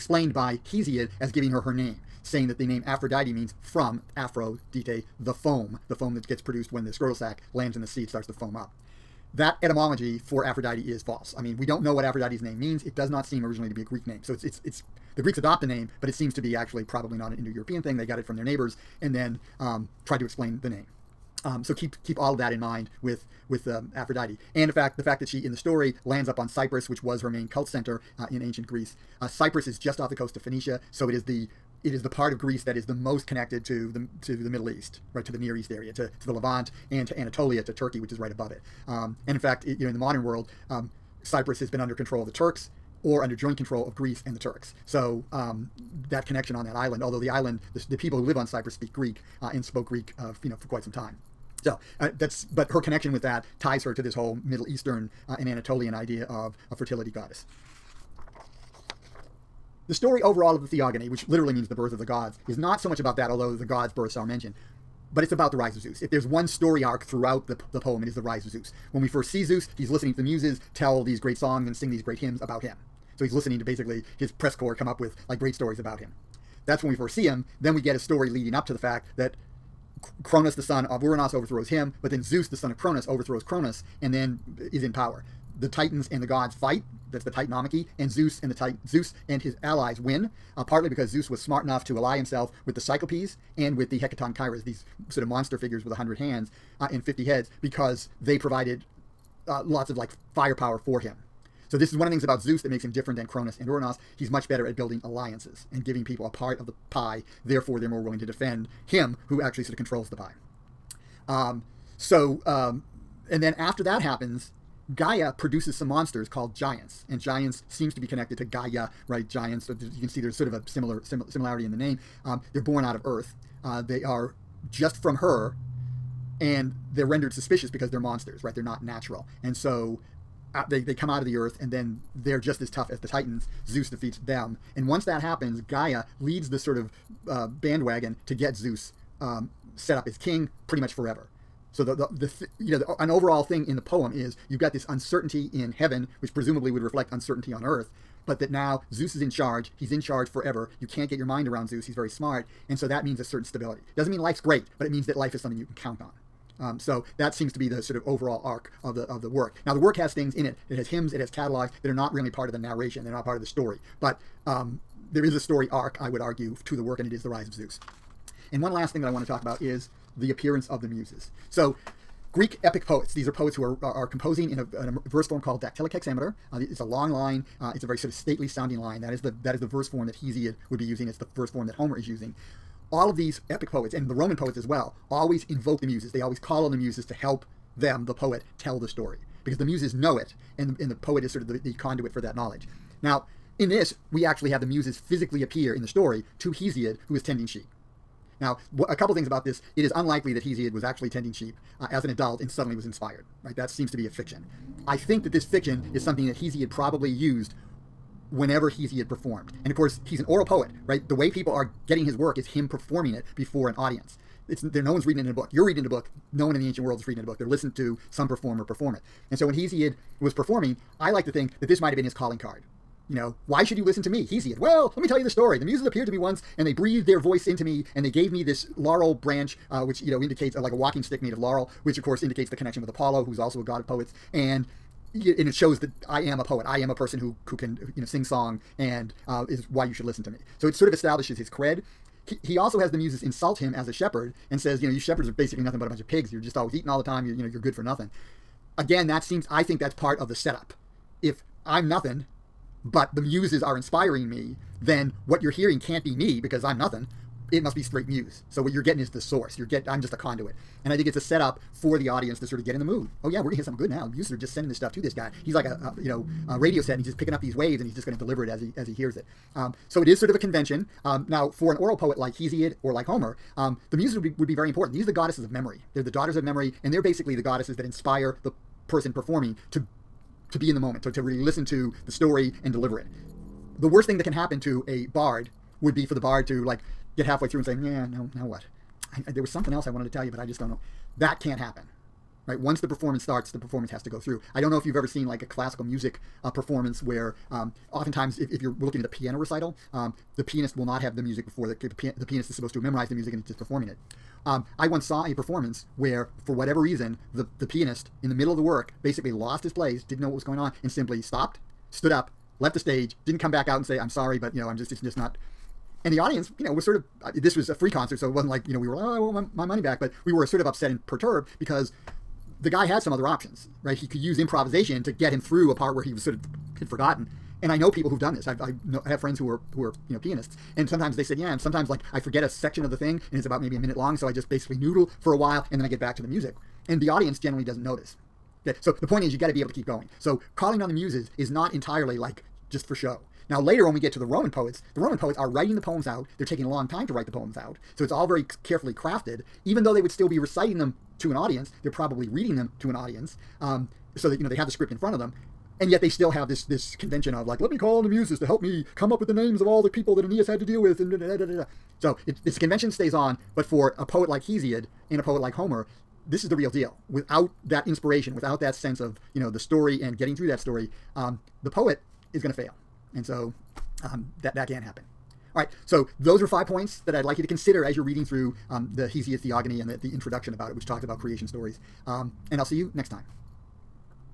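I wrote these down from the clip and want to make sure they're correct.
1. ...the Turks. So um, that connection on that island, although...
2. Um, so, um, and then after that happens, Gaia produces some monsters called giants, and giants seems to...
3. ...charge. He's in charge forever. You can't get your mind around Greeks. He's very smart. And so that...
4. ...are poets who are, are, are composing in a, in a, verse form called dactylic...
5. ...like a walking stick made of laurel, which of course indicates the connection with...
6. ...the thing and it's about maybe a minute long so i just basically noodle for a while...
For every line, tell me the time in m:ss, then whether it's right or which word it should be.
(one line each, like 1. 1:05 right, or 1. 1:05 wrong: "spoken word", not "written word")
1. 0:44 right
2. 1:51 right
3. 2:29 wrong: "Zeus", not "Greeks"
4. 2:53 right
5. 3:50 right
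6. 5:32 right.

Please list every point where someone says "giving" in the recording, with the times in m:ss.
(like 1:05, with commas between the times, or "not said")
0:01, 1:45.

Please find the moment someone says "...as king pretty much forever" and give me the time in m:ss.
2:20.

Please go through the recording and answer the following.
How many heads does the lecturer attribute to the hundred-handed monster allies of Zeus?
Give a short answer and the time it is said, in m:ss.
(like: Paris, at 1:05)
50, at 1:37.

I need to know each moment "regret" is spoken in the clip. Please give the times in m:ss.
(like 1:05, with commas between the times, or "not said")
not said.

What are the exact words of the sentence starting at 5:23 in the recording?
He could use improvisation to get him through a part where he was sort of had forgotten.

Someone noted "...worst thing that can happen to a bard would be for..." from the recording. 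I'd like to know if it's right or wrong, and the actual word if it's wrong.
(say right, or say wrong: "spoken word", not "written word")
right.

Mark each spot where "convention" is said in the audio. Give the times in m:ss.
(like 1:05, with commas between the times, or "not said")
4:30, 5:56, 6:02.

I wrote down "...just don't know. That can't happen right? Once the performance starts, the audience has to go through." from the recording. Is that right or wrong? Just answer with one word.
wrong.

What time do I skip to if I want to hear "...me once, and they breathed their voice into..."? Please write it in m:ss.
3:46.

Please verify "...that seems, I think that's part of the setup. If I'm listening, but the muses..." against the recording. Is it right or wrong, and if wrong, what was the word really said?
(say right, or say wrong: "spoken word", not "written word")
wrong: "nothing", not "listening".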